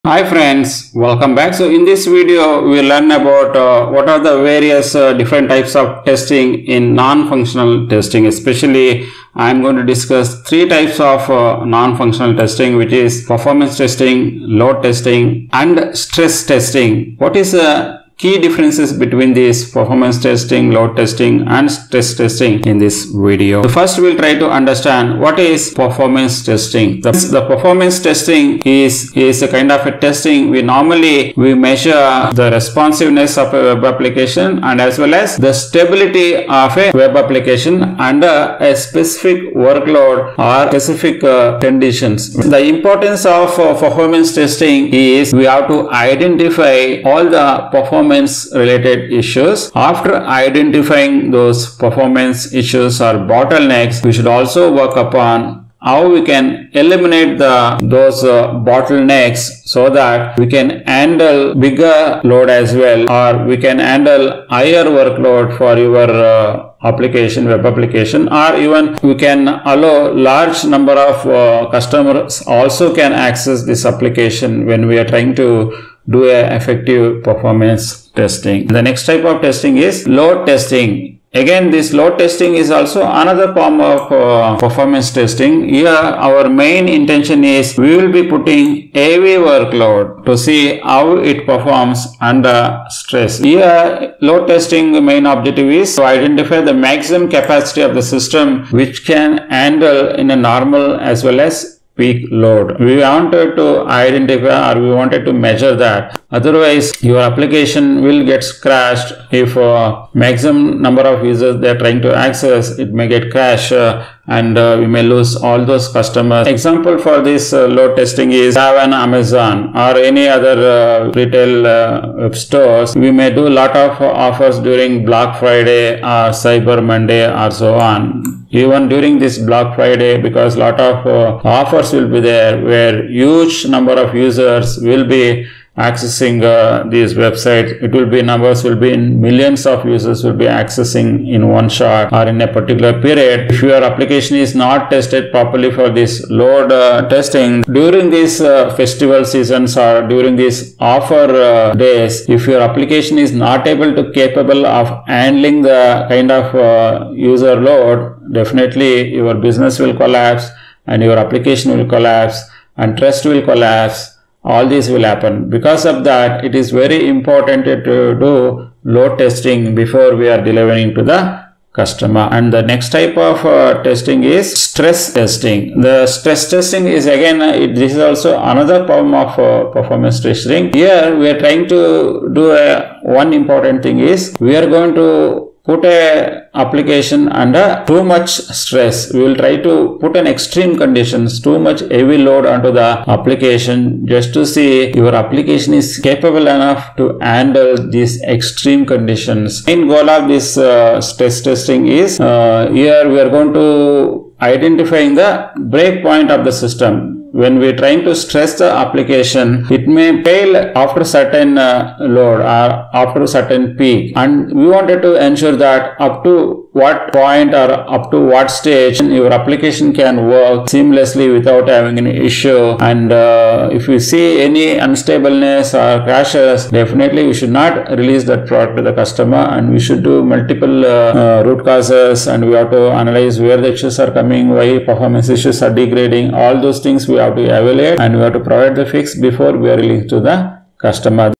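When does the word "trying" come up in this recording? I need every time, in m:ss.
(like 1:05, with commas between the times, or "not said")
1:15, 1:51, 3:01, 3:27.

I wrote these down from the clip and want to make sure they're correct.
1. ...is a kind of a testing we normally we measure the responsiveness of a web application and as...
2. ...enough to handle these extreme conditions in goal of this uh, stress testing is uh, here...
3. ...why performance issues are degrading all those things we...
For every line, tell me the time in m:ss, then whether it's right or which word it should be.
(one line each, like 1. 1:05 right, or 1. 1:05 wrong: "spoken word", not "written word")
1. 0:29 right
2. 3:16 right
3. 3:54 right.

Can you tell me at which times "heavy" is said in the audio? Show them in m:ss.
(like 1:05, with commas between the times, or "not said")
1:28, 3:11.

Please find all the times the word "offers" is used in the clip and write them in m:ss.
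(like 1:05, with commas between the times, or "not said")
2:04, 2:11, 2:30.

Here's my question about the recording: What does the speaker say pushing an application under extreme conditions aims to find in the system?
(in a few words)
breakpoint.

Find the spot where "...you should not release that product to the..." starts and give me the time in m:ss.
3:47.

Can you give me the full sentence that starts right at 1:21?
Again, this load testing is also another form of uh, performance testing.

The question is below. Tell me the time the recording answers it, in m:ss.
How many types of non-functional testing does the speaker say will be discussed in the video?
0:10.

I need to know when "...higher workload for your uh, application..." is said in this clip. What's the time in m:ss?
1:04.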